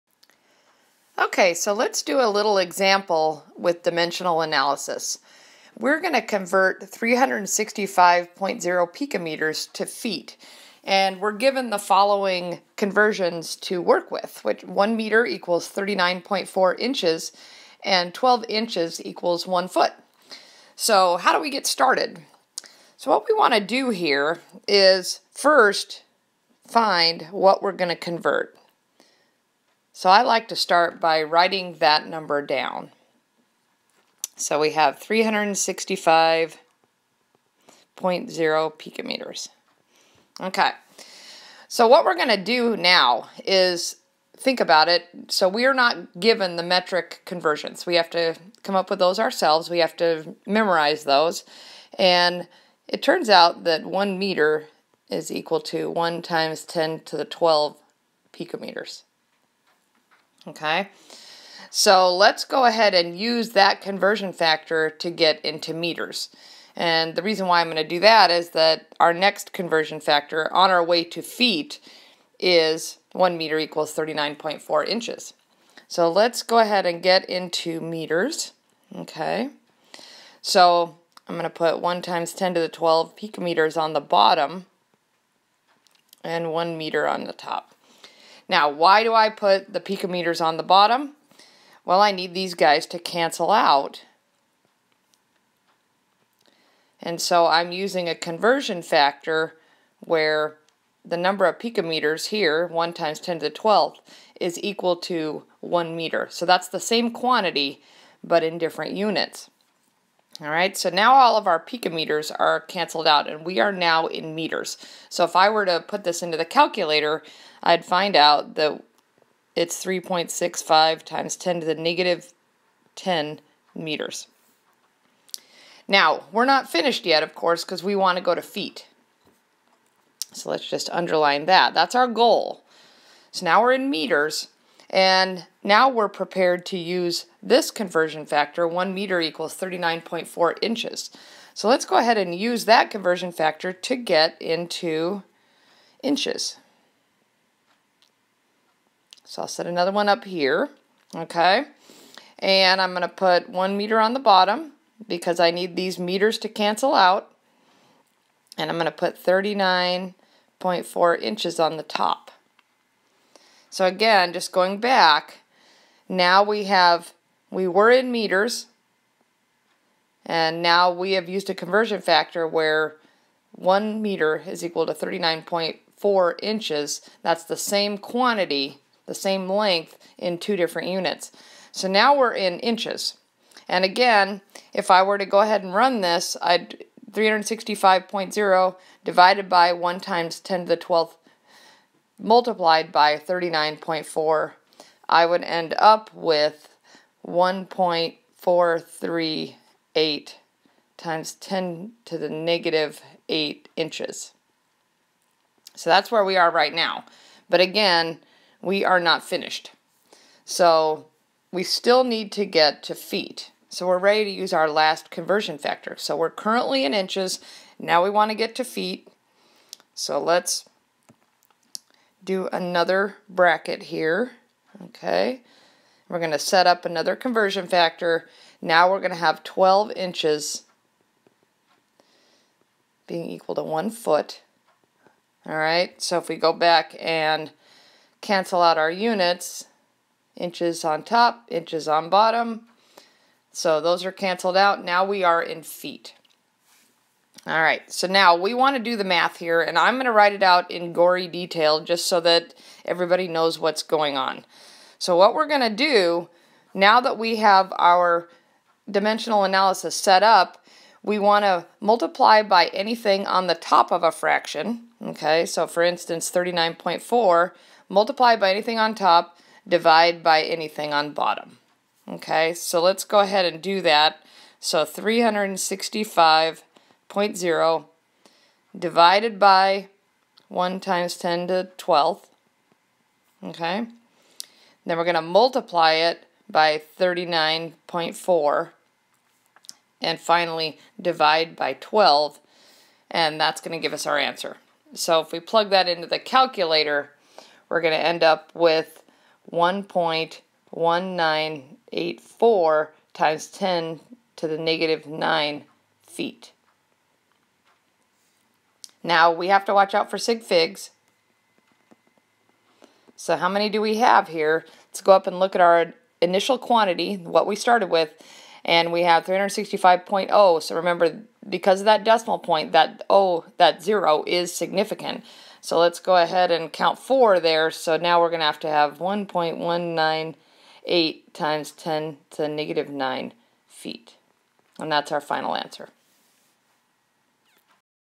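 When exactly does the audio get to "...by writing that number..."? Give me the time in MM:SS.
00:30.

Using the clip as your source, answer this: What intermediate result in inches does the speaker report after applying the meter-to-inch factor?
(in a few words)
1.438 x 10^-8 inches.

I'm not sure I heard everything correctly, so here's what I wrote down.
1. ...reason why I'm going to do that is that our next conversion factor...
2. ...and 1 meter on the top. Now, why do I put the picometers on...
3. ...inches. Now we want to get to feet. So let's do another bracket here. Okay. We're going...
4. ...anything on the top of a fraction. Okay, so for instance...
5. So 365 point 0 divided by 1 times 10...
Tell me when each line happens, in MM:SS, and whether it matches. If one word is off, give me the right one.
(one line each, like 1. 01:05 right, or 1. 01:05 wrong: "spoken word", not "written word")
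1. 01:07 right
2. 01:26 right
3. 03:36 right
4. 04:22 right
5. 04:34 right.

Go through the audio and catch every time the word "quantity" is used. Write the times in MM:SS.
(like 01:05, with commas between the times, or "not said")
01:47, 02:57, 05:16.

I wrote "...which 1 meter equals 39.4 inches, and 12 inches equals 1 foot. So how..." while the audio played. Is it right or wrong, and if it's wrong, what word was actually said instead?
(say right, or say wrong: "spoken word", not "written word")
right.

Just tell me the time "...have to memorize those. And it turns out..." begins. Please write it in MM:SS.
00:49.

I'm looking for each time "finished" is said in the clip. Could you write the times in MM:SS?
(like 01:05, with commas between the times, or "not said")
02:06, 03:29.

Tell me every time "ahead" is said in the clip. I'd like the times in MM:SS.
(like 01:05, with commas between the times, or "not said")
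01:02, 01:16, 02:21, 03:05, 04:33, 05:26.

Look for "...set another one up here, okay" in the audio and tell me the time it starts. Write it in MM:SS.
02:29.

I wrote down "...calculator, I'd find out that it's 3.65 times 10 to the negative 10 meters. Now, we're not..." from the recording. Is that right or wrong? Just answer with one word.
right.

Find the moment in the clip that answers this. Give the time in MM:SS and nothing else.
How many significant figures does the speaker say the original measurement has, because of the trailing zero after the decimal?
05:26.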